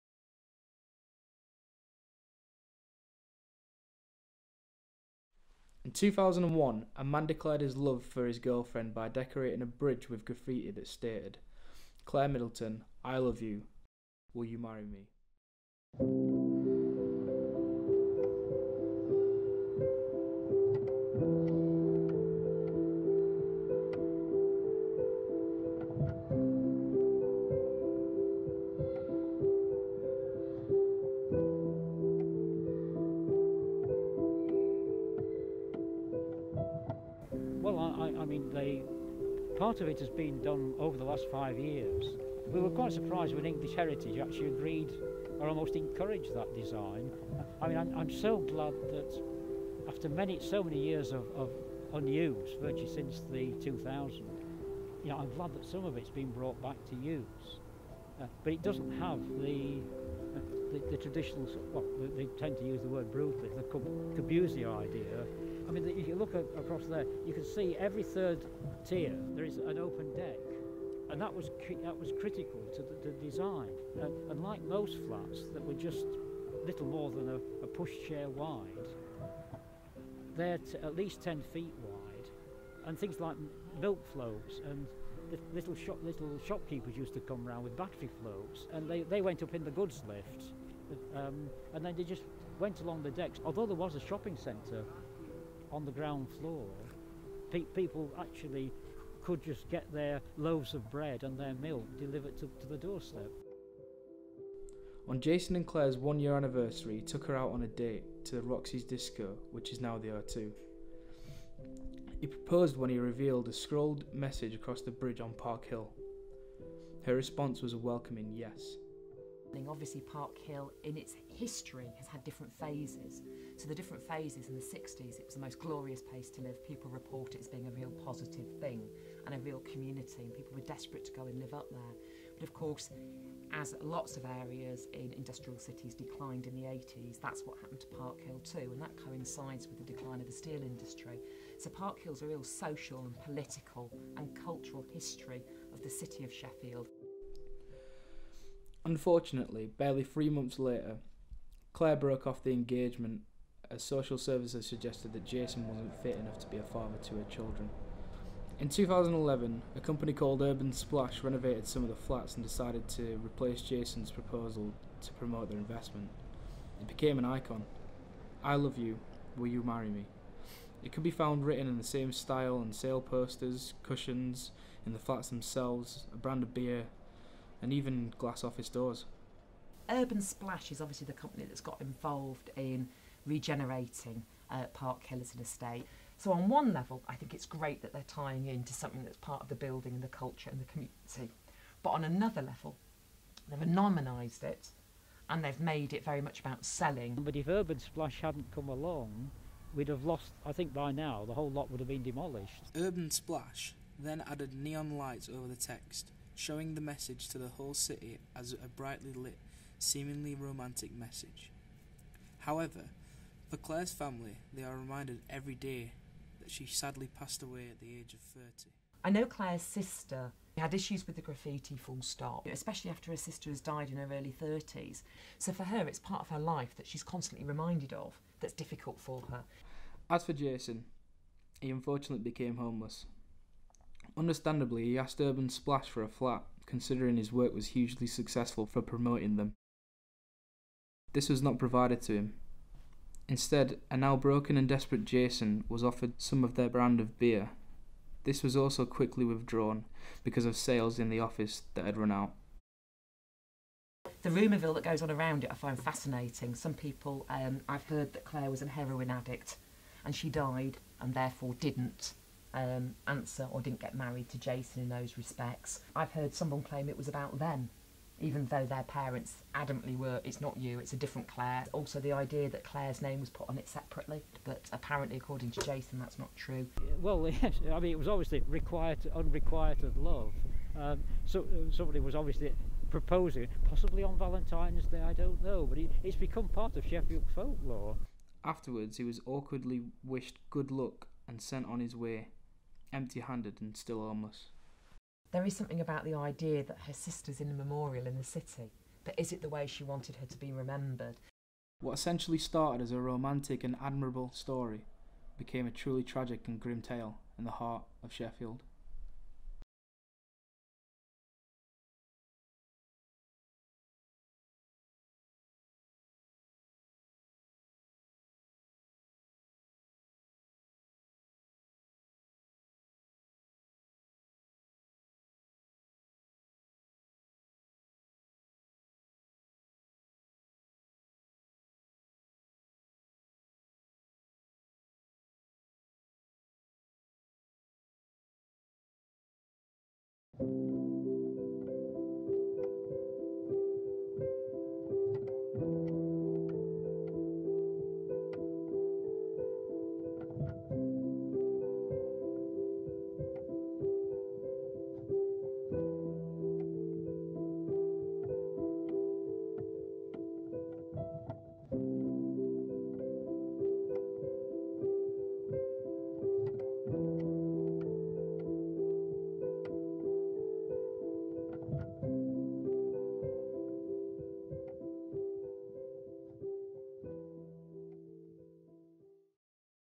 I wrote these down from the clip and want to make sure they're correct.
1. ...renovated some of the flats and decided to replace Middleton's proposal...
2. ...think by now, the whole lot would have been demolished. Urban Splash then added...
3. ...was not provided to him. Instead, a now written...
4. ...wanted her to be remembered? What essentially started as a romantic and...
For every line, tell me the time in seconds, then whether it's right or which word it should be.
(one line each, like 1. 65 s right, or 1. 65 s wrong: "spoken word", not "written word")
1. 161 s wrong: "Jason", not "Middleton"
2. 200 s right
3. 241 s wrong: "broken", not "written"
4. 299 s right.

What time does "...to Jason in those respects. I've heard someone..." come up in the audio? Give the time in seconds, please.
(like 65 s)
264 s.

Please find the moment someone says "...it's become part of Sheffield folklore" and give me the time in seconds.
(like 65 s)
286 s.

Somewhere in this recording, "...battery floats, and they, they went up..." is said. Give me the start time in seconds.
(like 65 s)
87 s.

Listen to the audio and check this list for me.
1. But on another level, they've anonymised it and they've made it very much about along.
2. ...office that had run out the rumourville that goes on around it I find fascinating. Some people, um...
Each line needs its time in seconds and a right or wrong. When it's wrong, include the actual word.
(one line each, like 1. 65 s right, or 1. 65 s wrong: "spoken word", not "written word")
1. 191 s wrong: "selling", not "along"
2. 251 s right.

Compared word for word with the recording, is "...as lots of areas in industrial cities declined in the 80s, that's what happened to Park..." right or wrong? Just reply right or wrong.
right.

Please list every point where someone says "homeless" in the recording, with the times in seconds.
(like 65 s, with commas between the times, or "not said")
232 s, 294 s.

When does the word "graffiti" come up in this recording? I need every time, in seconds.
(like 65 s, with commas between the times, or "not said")
10 s, 221 s.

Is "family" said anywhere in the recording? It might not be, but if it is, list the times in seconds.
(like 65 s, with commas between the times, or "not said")
213 s.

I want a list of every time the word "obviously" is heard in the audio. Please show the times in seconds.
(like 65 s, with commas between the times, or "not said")
119 s, 180 s, 278 s, 282 s.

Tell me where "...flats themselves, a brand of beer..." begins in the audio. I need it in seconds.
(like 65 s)
174 s.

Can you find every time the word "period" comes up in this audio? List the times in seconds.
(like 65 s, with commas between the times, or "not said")
not said.